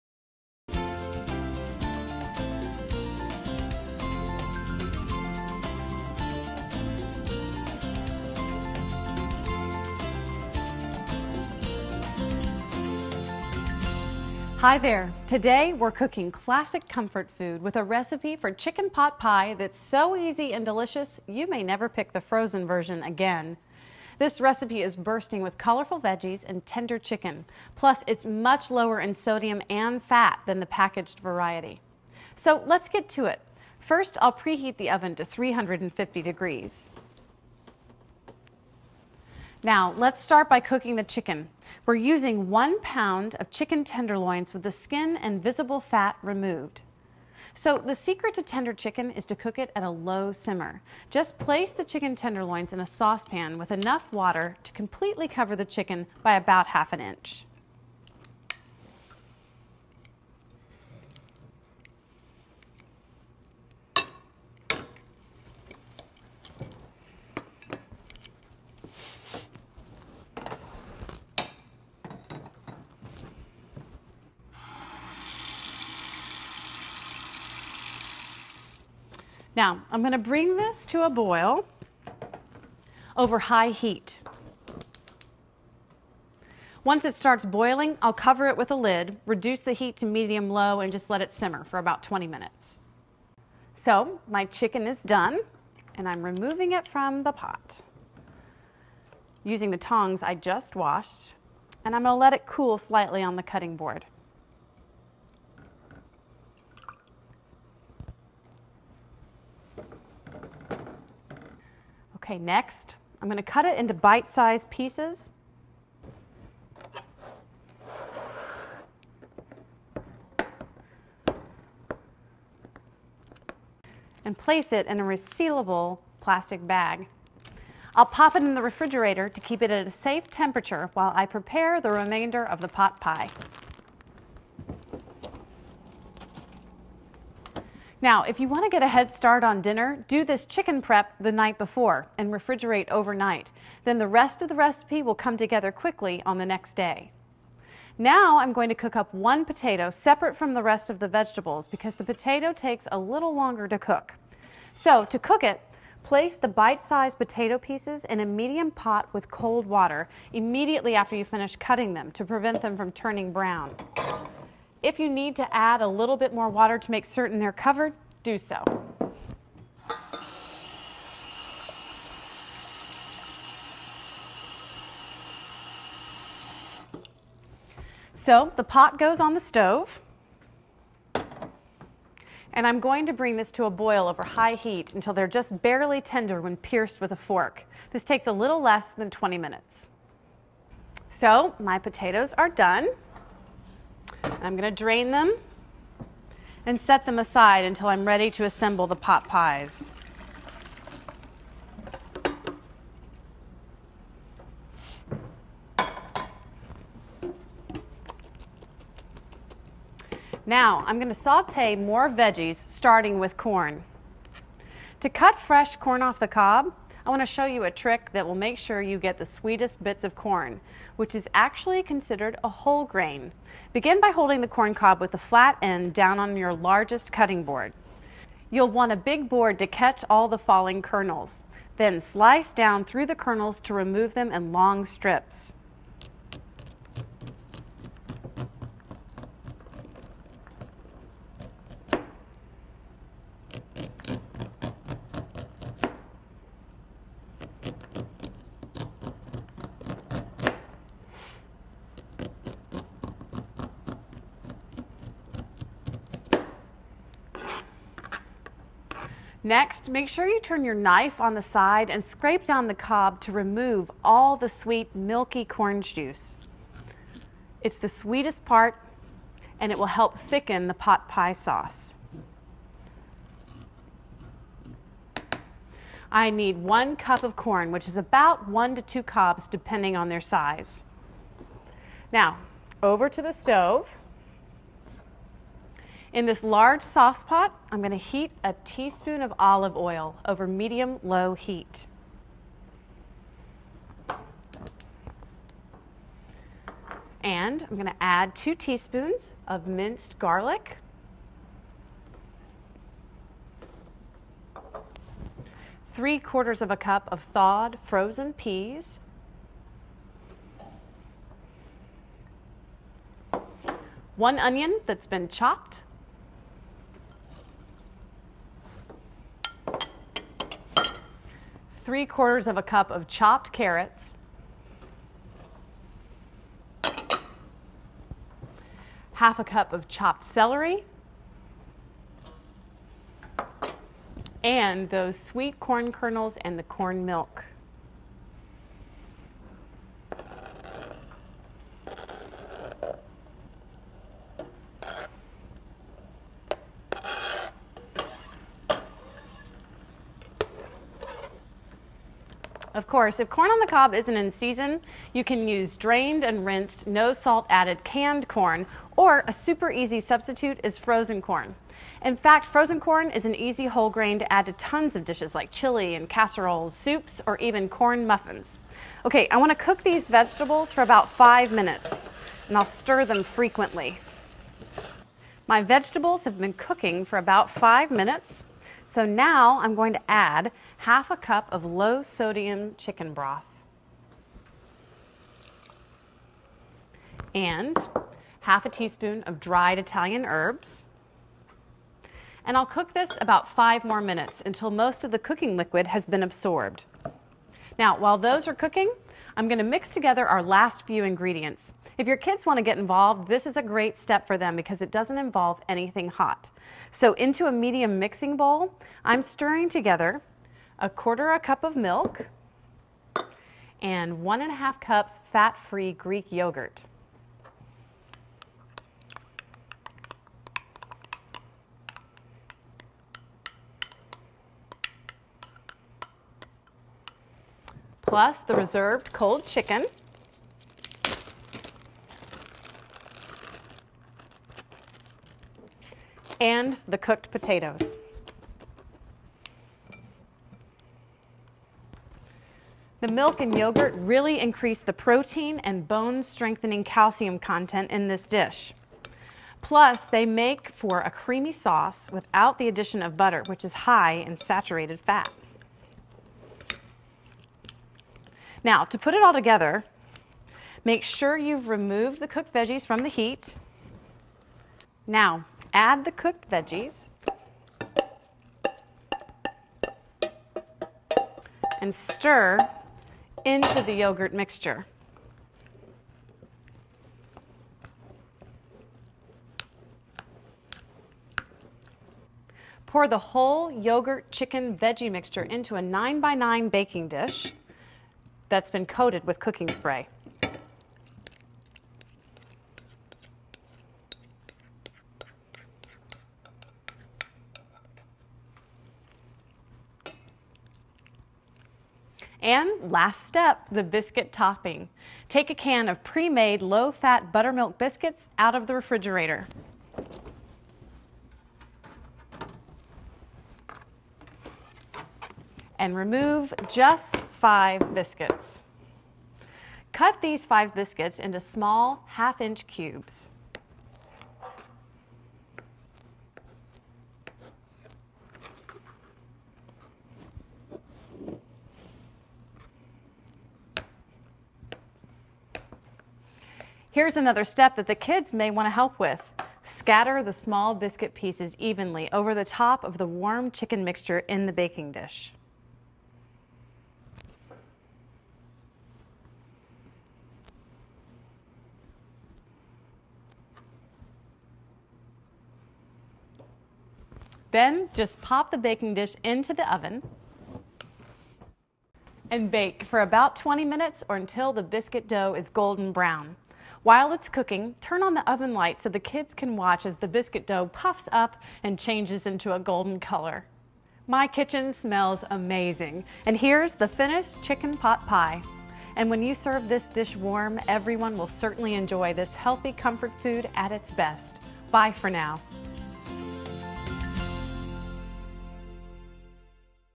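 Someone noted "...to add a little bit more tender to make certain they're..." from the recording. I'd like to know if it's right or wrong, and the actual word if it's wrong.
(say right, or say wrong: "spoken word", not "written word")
wrong: "water", not "tender".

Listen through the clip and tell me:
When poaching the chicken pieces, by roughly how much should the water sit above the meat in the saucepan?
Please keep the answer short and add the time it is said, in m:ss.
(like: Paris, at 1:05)
half an inch, at 0:56.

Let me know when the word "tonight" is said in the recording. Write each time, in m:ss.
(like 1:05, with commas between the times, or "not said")
not said.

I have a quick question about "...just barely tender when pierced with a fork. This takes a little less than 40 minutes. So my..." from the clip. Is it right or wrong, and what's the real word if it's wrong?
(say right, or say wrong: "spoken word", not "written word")
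wrong: "20", not "40".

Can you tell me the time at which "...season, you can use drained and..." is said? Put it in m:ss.
5:54.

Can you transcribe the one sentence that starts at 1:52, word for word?
Okay, next, I'm going to cut it into bite-sized pieces.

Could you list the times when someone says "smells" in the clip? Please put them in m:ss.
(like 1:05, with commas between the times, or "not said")
9:34.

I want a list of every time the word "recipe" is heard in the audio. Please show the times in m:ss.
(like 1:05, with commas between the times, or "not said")
0:17, 0:24, 2:24.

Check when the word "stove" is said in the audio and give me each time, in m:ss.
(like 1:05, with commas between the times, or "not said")
2:59, 4:43.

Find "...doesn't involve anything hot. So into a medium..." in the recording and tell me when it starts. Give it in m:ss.
6:44.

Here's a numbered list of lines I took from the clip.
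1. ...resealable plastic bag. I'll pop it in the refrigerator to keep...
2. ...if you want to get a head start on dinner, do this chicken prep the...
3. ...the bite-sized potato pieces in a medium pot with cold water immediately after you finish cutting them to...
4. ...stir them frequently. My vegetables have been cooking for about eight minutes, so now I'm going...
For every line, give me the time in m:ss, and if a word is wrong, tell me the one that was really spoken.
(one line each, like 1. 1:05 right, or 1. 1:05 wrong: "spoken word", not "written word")
1. 2:05 right
2. 2:18 right
3. 2:36 right
4. 6:12 wrong: "five", not "eight".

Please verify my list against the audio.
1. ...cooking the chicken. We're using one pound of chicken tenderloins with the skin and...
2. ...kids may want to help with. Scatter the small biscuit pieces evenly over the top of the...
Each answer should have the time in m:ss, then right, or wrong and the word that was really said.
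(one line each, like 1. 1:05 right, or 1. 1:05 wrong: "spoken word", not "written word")
1. 0:40 right
2. 8:57 right.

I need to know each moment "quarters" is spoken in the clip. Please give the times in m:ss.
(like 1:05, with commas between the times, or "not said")
5:06, 5:22, 6:50.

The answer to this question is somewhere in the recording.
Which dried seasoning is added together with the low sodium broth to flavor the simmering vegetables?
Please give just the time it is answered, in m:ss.
6:29.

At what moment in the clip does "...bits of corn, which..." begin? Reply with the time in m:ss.
3:39.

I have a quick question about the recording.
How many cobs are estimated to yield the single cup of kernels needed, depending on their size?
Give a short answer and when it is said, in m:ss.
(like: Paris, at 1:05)
1 to 2, at 4:38.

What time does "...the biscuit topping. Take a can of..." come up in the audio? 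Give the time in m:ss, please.
8:23.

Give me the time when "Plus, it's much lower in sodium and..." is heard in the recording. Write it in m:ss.
0:27.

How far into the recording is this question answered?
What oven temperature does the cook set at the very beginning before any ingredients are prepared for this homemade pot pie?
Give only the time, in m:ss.
0:35.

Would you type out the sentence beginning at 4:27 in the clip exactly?
It's the sweetest part and it will help thicken the pot pie sauce.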